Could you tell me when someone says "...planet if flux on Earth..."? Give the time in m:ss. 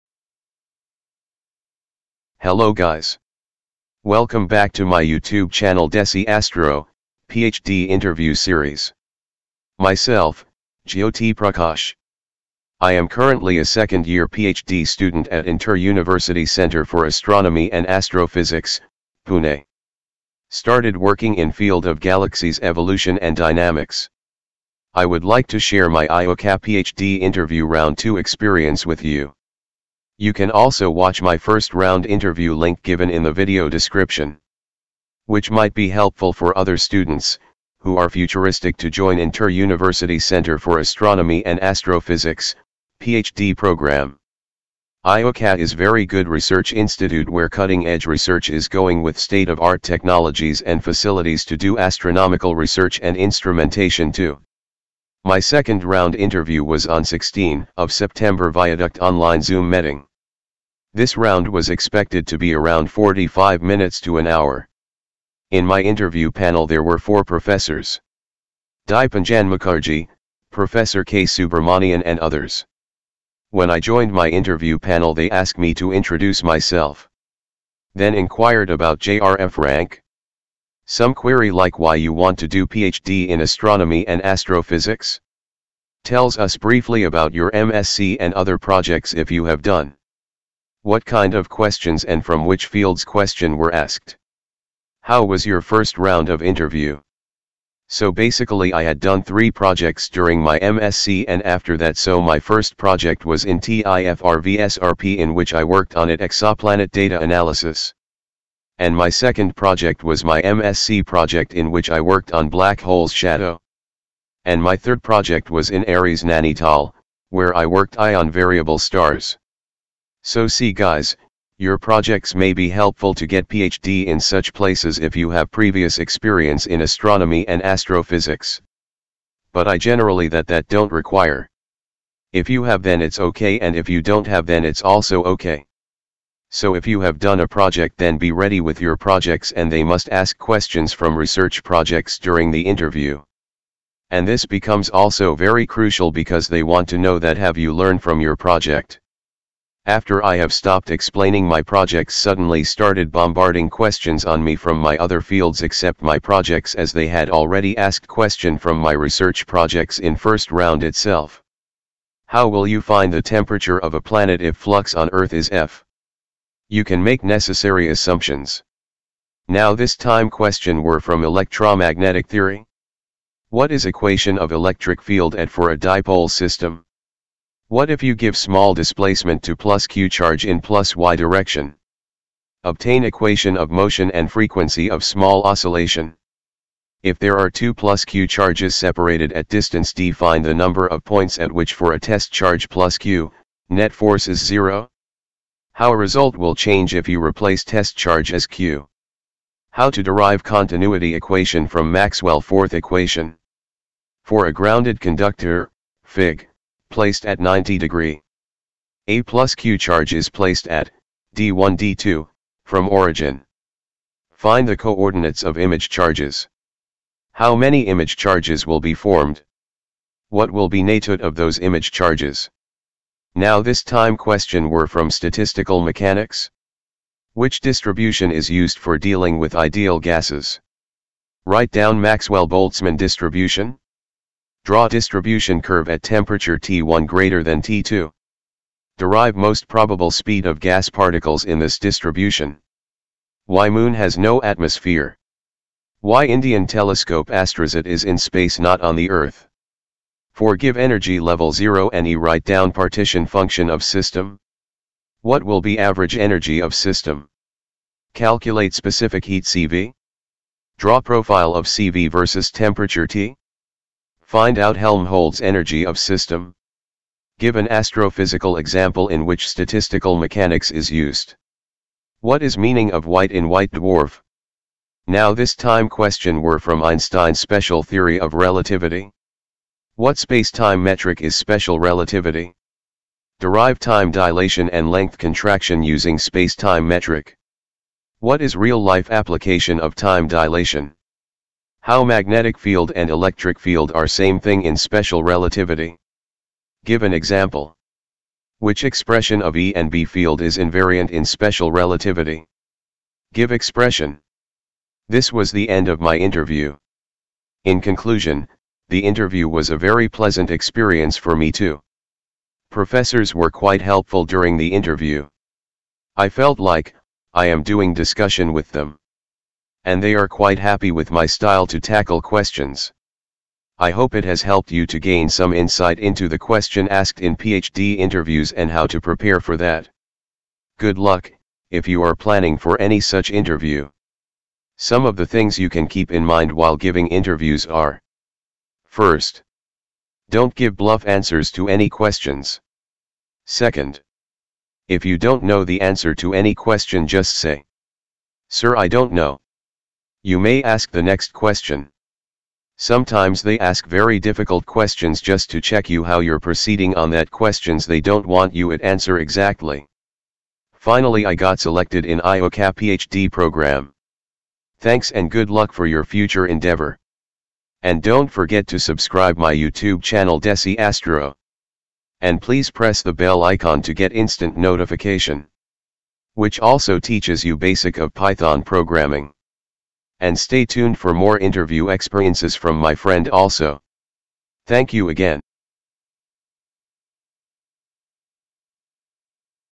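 2:44.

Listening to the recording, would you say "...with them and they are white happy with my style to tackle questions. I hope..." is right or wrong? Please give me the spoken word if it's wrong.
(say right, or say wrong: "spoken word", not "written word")
wrong: "quite", not "white".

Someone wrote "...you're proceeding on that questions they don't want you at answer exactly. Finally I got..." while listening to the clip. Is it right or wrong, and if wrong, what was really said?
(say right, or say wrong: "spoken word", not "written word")
right.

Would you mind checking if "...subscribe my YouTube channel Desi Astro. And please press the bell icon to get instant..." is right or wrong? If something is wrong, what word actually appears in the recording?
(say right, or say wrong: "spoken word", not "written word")
right.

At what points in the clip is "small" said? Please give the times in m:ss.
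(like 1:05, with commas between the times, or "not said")
2:58, 3:05.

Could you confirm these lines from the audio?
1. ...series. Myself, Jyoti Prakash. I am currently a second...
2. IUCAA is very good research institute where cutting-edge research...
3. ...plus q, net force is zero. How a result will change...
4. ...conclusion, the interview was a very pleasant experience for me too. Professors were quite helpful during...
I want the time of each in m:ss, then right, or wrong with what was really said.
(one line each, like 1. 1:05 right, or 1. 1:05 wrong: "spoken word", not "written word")
1. 0:08 right
2. 0:45 right
3. 3:12 right
4. 5:07 right.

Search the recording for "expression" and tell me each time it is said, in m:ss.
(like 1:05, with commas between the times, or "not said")
4:58, 5:03.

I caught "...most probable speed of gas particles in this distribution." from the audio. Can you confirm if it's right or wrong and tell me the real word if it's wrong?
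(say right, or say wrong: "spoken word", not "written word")
right.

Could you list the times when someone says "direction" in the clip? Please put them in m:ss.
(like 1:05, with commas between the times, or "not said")
3:01.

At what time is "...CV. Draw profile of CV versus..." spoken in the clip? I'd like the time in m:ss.
4:19.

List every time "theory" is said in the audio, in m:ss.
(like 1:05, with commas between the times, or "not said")
2:52, 4:37.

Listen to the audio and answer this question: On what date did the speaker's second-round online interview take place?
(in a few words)
16 September.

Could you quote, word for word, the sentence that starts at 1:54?
And my third project was in Aries Nainital, where I worked ion variable stars.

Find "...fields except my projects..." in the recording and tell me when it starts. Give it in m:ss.
2:35.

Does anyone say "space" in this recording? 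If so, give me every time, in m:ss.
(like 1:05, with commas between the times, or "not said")
4:08, 4:40, 4:46.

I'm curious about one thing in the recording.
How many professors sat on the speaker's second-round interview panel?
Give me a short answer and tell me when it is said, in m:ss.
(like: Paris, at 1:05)
4, at 1:06.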